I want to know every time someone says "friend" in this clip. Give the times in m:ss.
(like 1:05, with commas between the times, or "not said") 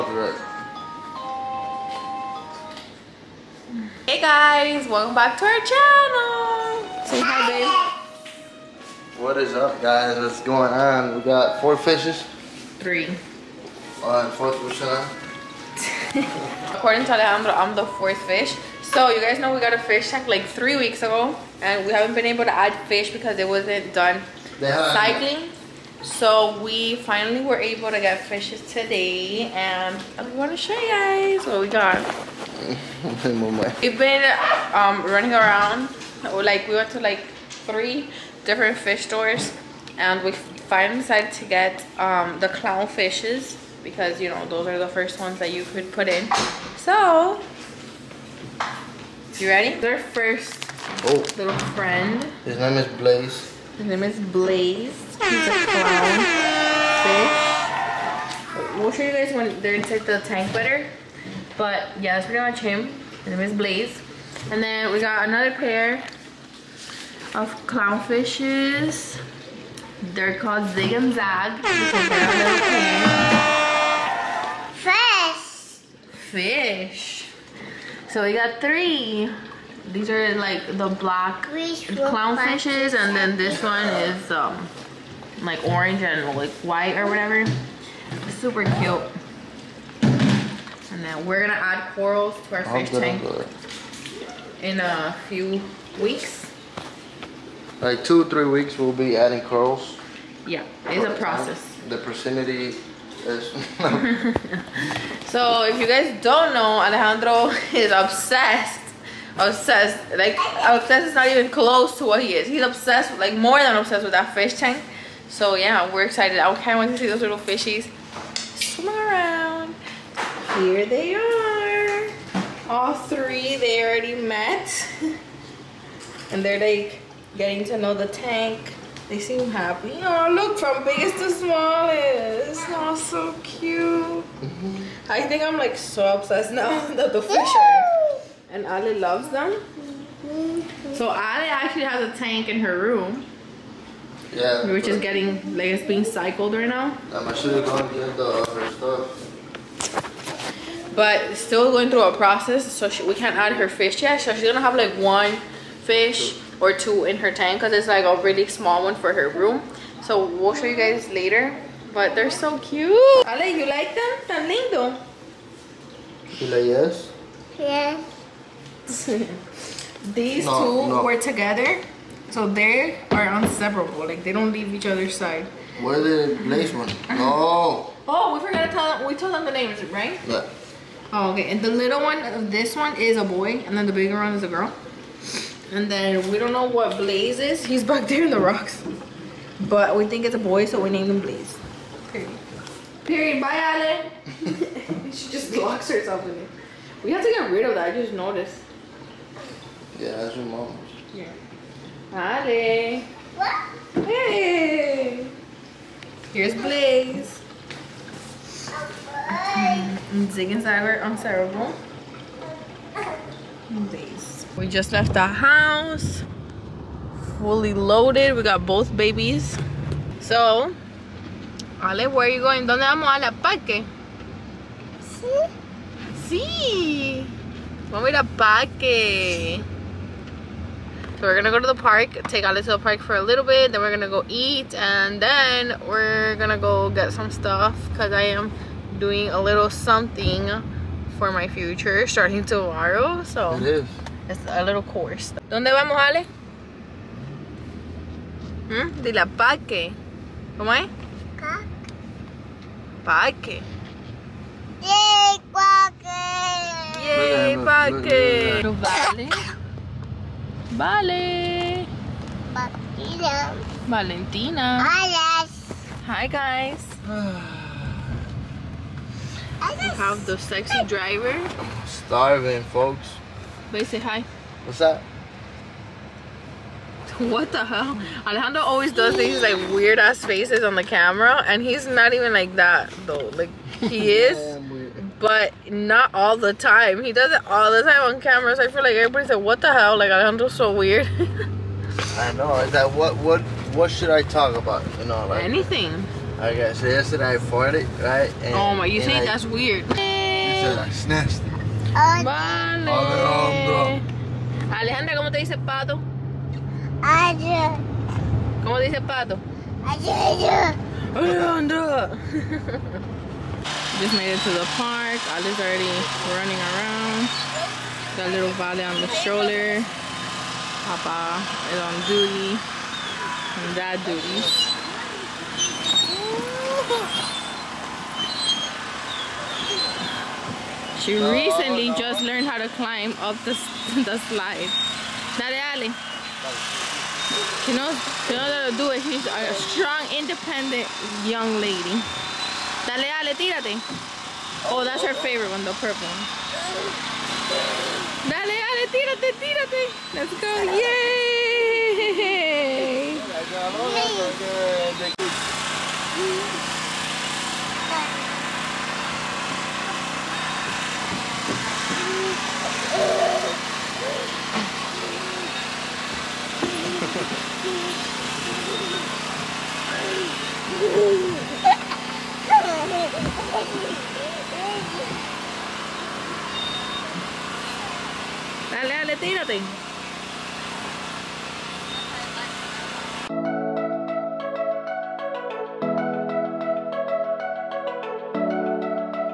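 0:51.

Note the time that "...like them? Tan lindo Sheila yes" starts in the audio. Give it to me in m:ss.
2:43.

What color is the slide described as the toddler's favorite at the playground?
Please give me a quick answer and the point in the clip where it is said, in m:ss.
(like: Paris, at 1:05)
Purple, at 5:45.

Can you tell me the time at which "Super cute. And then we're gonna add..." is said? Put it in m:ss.
1:28.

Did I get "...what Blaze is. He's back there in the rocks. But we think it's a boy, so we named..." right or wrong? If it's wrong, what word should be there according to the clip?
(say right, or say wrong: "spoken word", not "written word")
right.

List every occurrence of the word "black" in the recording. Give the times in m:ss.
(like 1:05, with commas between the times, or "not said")
1:20.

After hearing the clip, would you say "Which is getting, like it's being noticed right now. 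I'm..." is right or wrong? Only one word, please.
wrong.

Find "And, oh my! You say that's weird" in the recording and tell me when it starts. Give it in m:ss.
4:58.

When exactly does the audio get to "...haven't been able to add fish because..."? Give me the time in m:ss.
0:21.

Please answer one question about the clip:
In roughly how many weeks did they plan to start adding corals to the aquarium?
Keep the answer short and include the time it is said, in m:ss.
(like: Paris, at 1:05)
2 or 3 weeks, at 1:37.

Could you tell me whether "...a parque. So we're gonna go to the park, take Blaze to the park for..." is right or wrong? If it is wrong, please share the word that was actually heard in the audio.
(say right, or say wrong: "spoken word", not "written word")
wrong: "Ale", not "Blaze".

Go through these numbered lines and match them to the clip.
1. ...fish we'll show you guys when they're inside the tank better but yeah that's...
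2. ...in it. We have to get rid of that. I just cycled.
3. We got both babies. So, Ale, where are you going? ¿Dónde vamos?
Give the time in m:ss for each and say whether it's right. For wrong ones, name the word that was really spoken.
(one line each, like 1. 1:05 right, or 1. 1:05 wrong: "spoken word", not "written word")
1. 0:56 right
2. 3:16 wrong: "noticed", not "cycled"
3. 3:38 right.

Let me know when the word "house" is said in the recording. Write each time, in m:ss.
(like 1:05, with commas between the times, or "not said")
3:35.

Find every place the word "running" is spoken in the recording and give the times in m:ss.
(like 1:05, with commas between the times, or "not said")
0:35, 5:16.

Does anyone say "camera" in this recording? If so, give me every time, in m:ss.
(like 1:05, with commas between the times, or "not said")
4:40, 4:48.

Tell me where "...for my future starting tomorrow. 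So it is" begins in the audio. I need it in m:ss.
4:01.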